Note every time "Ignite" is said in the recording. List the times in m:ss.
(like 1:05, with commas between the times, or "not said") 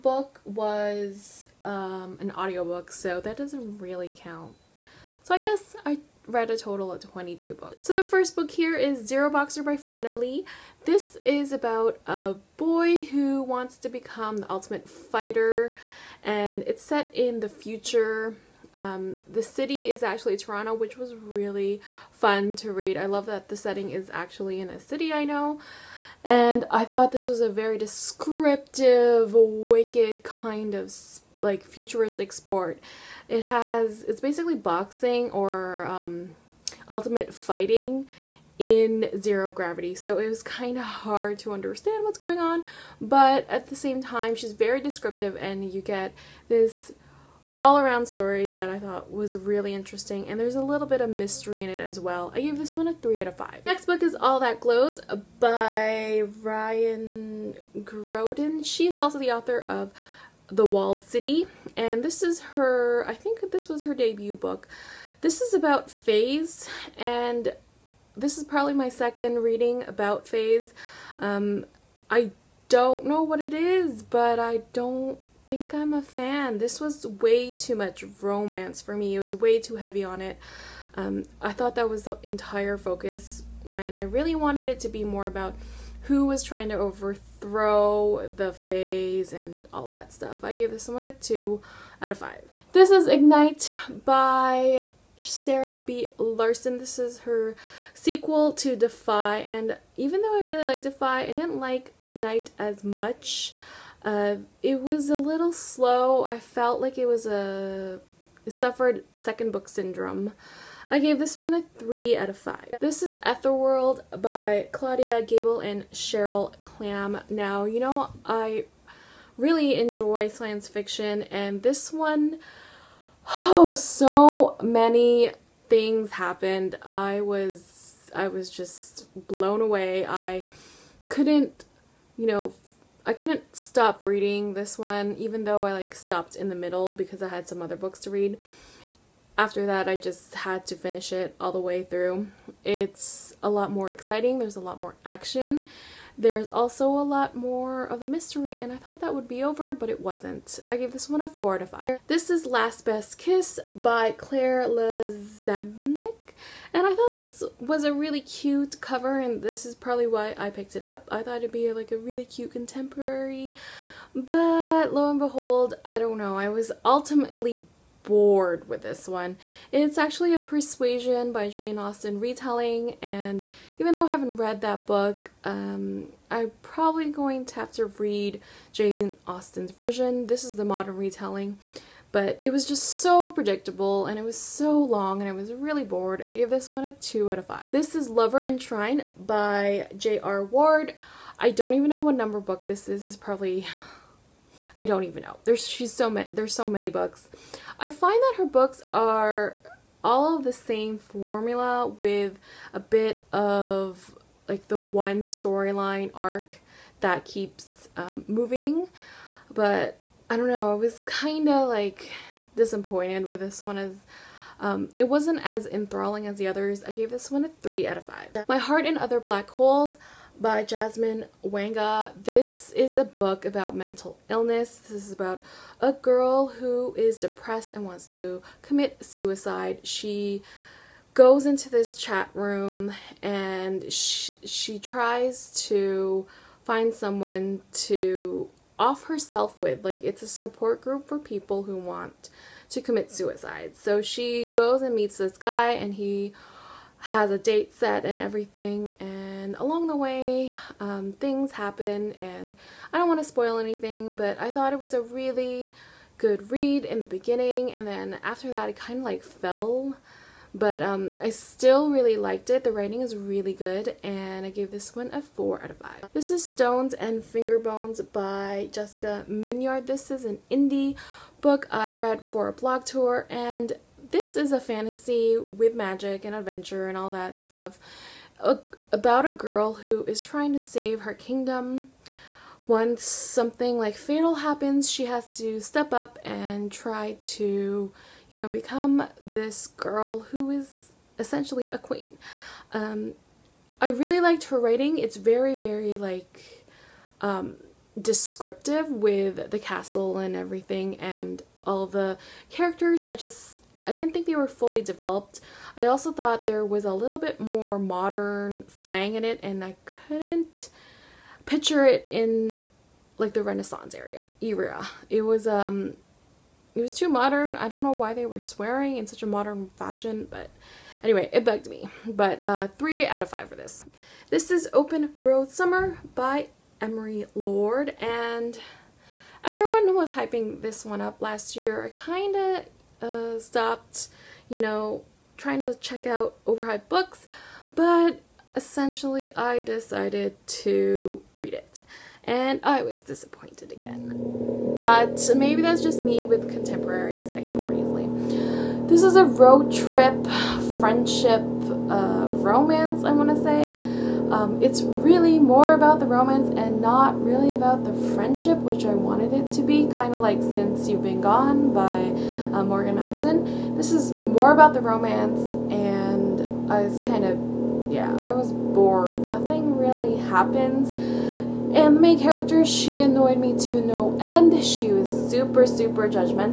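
1:33, 1:42.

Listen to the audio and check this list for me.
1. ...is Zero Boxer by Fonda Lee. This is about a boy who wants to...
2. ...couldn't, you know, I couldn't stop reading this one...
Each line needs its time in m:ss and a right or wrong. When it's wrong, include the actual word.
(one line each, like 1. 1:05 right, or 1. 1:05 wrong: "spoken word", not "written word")
1. 0:08 right
2. 2:11 right.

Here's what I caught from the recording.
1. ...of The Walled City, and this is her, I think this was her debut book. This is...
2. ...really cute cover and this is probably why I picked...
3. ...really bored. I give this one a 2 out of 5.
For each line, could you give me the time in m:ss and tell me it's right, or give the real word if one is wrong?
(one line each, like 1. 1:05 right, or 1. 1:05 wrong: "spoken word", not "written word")
1. 0:59 right
2. 2:37 right
3. 3:05 right.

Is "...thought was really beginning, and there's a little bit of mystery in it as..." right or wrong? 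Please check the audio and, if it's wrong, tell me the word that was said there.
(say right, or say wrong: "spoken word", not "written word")
wrong: "interesting", not "beginning".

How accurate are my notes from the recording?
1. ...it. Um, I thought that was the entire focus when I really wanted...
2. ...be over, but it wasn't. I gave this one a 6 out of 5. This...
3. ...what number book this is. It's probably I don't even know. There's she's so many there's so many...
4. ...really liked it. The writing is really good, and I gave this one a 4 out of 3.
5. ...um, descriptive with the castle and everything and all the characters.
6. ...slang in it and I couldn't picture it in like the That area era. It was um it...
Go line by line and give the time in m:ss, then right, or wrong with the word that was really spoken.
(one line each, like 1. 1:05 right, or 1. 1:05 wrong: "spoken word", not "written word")
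1. 1:20 right
2. 2:29 wrong: "4", not "6"
3. 3:12 right
4. 4:21 wrong: "5", not "3"
5. 4:57 right
6. 5:08 wrong: "Renaissance", not "That".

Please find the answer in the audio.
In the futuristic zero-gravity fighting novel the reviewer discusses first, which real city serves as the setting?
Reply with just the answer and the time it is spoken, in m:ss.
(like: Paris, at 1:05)
Toronto, at 0:20.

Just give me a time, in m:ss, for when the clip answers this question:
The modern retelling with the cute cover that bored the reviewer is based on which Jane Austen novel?
2:50.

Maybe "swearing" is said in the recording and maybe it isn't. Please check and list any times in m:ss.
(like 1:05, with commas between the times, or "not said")
5:18.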